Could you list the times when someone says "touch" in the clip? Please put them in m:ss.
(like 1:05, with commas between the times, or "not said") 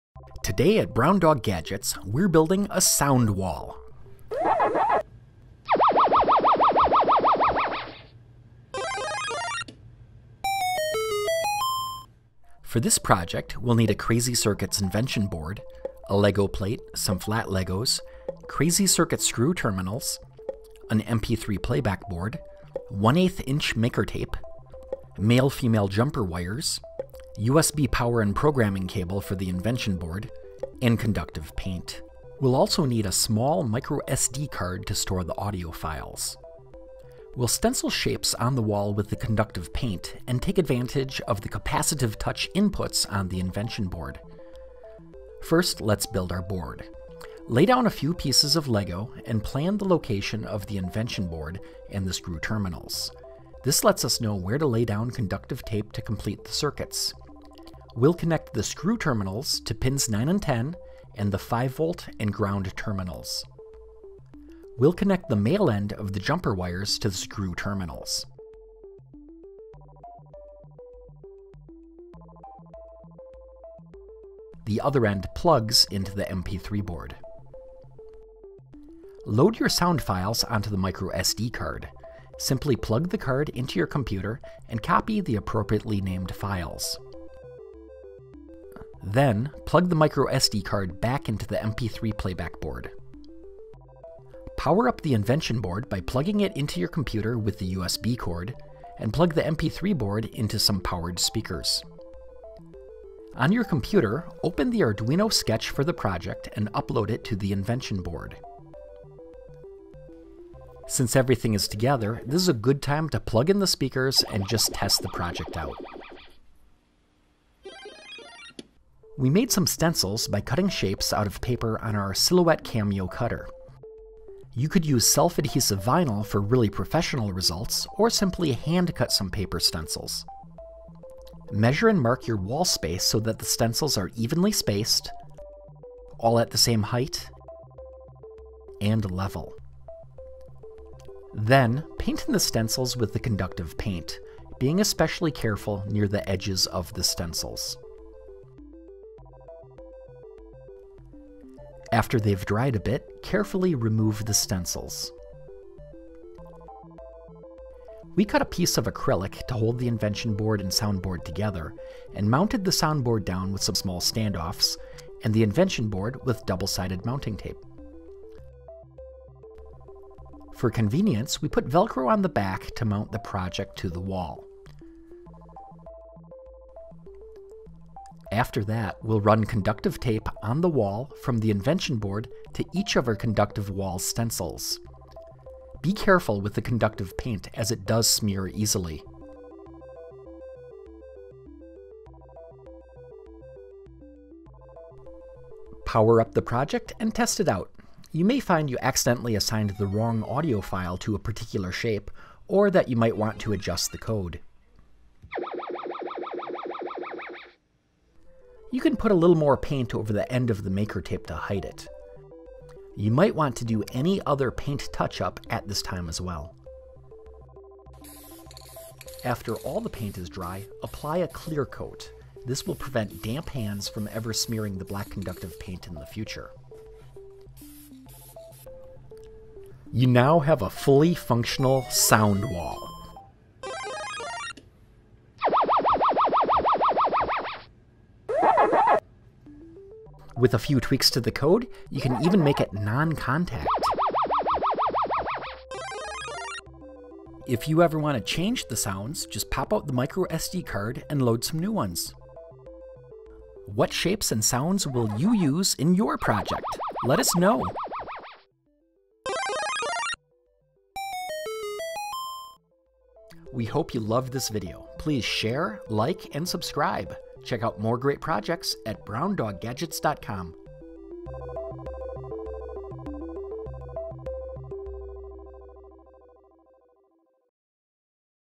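0:42, 3:34.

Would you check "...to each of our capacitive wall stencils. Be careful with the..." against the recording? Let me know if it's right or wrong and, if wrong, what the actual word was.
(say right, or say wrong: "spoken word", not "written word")
wrong: "conductive", not "capacitive".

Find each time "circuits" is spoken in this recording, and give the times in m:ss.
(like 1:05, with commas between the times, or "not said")
0:14, 0:18, 0:56.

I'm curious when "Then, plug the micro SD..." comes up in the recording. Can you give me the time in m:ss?
1:29.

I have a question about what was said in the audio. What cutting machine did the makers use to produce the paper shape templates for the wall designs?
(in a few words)
Silhouette Cameo.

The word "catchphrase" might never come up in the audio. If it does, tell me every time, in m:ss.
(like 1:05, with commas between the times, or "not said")
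not said.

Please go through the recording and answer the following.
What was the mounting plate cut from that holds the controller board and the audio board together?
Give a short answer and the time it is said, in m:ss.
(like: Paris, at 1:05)
Acrylic, at 2:38.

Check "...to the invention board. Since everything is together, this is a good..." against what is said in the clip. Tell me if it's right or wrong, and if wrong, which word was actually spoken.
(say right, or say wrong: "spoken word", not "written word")
right.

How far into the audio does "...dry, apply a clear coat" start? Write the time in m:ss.
3:40.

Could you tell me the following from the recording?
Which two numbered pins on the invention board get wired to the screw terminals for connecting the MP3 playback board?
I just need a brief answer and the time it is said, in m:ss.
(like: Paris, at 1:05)
9 and 10, at 0:59.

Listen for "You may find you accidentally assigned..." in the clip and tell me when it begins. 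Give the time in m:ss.
3:18.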